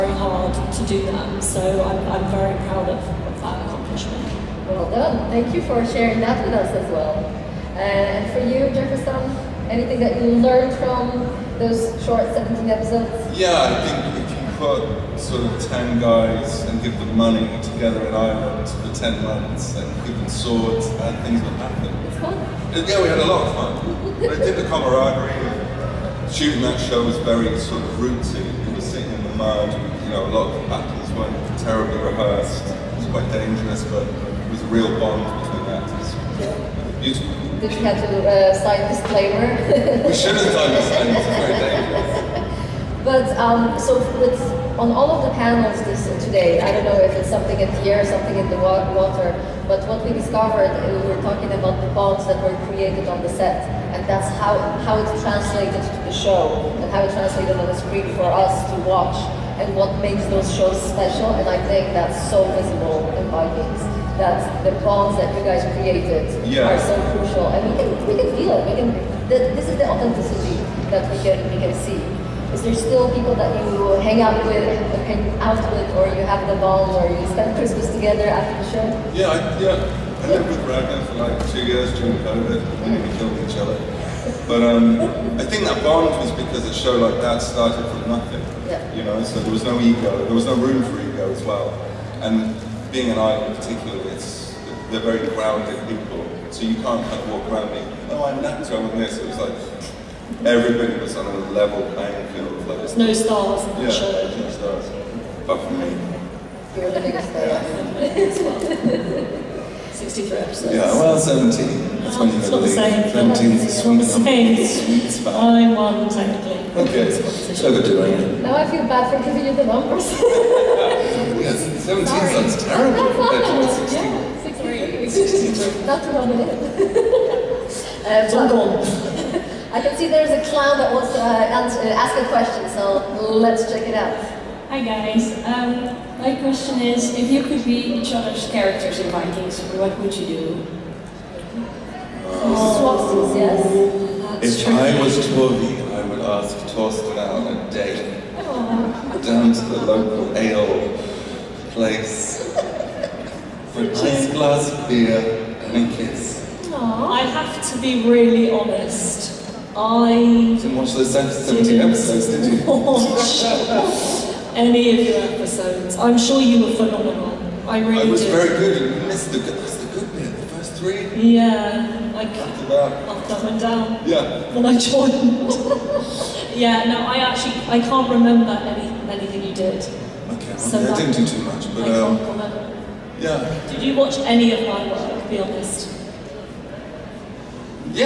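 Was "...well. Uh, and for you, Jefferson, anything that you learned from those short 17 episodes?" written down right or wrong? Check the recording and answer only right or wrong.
right.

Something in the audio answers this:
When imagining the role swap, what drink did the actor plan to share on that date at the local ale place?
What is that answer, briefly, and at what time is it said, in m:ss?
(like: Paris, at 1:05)
beer, at 2:34.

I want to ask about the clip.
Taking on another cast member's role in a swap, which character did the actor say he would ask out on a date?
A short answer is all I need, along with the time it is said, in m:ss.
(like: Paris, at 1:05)
Torstein, at 2:26.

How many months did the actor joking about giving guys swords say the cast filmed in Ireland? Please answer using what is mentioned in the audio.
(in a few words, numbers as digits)
10.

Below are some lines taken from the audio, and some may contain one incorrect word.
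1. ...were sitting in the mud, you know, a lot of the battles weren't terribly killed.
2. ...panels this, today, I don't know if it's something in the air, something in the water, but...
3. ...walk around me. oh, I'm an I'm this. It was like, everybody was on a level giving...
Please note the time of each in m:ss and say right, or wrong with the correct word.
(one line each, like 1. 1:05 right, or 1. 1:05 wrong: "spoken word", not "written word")
1. 0:28 wrong: "rehearsed", not "killed"
2. 0:45 right
3. 1:37 wrong: "playing", not "giving".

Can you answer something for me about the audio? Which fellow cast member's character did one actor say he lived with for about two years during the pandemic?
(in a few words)
Ragnar.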